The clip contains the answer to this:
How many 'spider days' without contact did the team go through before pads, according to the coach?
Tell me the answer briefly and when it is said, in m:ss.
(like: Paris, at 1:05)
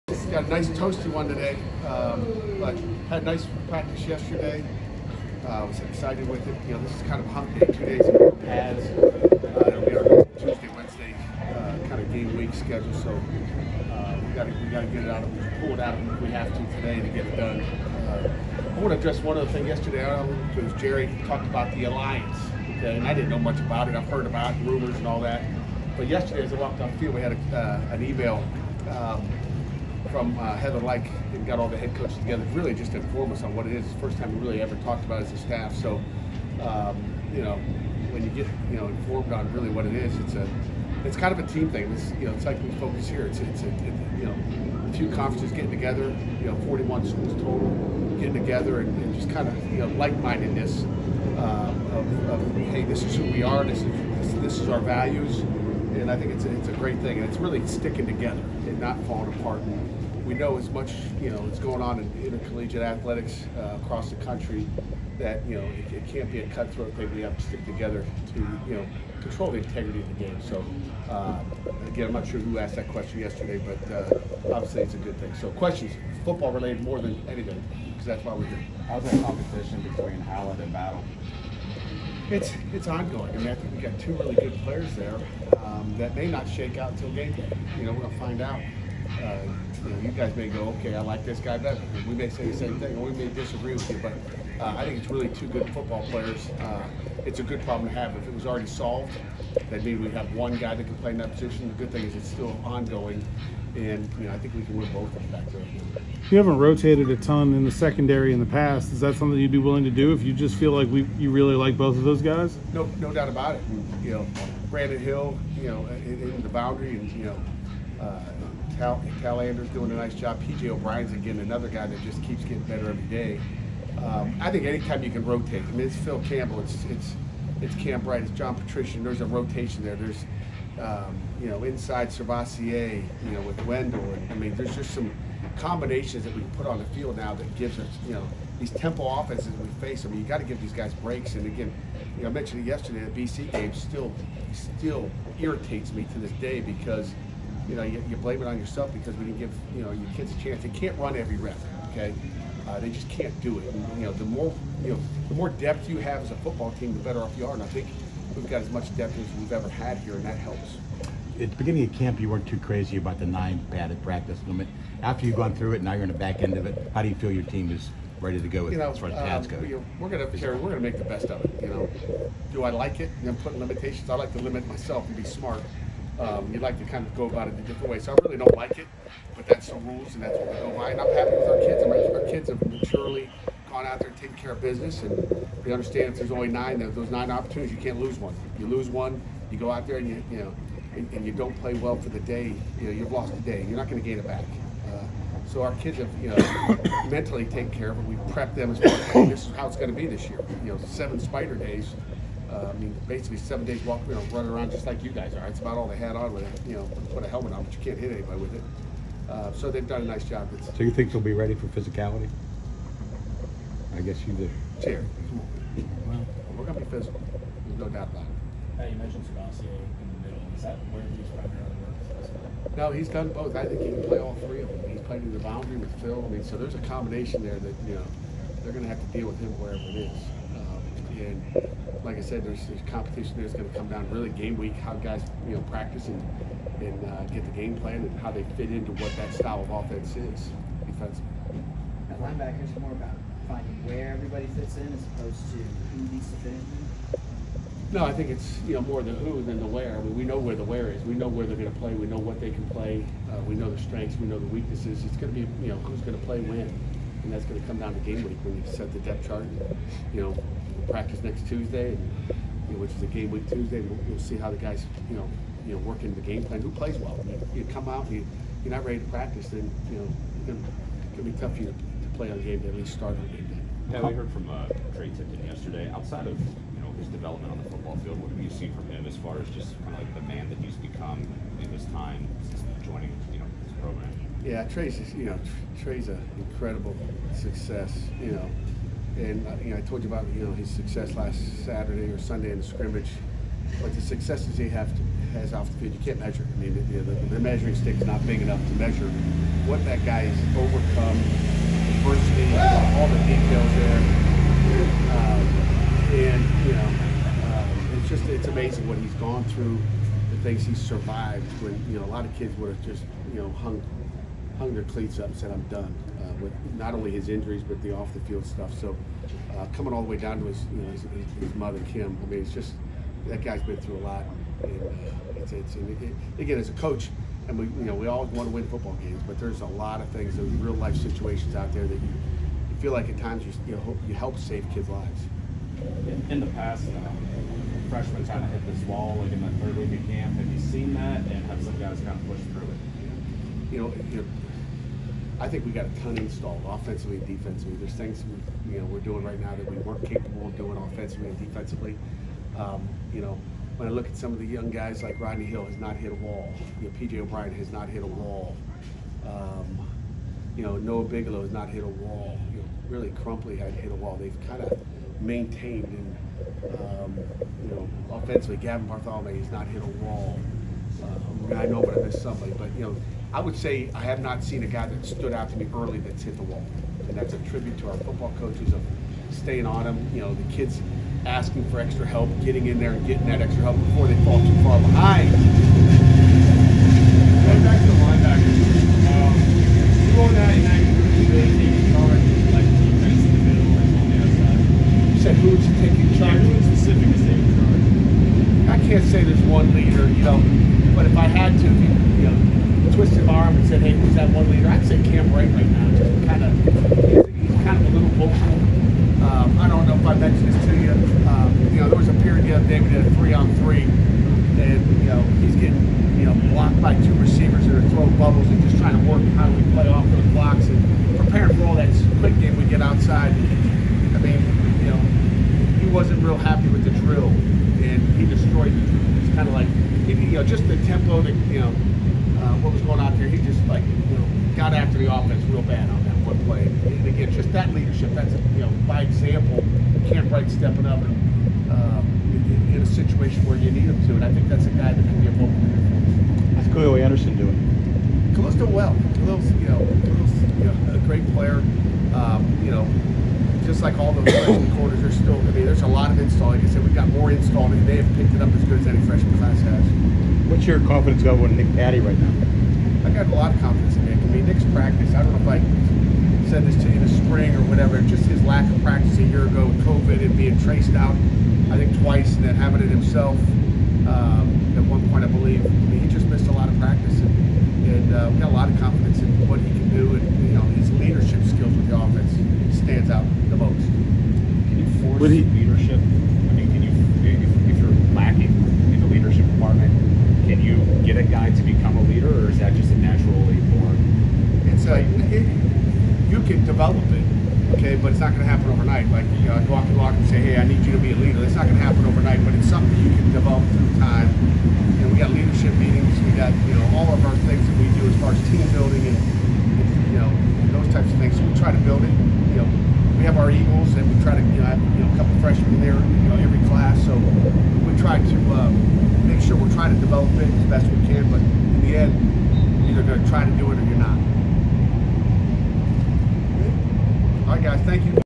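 7, at 3:20.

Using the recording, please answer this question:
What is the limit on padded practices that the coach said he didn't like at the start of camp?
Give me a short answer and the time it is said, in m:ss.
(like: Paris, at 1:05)
9, at 2:43.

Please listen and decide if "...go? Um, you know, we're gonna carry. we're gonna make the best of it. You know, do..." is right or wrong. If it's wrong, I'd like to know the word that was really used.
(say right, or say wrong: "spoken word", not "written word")
right.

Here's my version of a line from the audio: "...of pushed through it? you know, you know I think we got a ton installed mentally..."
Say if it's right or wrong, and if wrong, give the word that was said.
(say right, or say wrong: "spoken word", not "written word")
wrong: "offensively", not "mentally".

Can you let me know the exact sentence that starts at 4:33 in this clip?
Yeah, we heard from uh, Tre Tipton yesterday.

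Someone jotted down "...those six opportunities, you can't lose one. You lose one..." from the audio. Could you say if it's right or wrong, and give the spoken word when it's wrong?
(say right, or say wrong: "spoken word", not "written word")
wrong: "nine", not "six".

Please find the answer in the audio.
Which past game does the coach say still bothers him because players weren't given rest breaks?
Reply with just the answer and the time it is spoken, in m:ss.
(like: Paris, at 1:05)
BC, at 2:23.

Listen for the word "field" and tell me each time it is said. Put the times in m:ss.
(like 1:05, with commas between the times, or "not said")
0:26, 2:16, 4:37, 4:55, 5:18.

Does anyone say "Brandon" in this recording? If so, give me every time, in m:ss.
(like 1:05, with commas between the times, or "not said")
1:54.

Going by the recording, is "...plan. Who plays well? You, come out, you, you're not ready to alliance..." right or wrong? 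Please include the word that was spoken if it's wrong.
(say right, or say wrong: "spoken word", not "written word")
wrong: "practice", not "alliance".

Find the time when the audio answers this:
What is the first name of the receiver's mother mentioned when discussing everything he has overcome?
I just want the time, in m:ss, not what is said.
5:21.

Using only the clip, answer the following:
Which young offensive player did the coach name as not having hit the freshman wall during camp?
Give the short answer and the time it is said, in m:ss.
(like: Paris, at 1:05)
Gavin Bartholomew, at 6:08.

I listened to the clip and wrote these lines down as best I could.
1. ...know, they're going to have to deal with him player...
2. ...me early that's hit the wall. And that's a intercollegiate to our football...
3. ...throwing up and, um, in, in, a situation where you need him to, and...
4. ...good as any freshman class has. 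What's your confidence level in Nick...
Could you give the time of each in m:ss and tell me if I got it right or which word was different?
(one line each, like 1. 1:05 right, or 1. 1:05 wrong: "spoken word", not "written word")
1. 3:47 wrong: "wherever", not "player"
2. 6:15 wrong: "tribute", not "intercollegiate"
3. 7:20 wrong: "stepping", not "throwing"
4. 7:38 right.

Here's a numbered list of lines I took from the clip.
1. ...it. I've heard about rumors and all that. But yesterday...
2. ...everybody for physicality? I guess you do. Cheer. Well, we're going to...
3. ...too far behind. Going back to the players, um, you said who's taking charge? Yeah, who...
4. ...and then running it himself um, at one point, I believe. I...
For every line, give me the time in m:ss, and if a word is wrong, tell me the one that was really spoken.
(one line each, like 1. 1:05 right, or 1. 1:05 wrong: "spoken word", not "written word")
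1. 0:23 right
2. 3:31 wrong: "ready", not "everybody"
3. 6:24 wrong: "linebackers", not "players"
4. 7:52 wrong: "having", not "running".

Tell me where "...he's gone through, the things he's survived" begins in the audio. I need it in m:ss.
5:08.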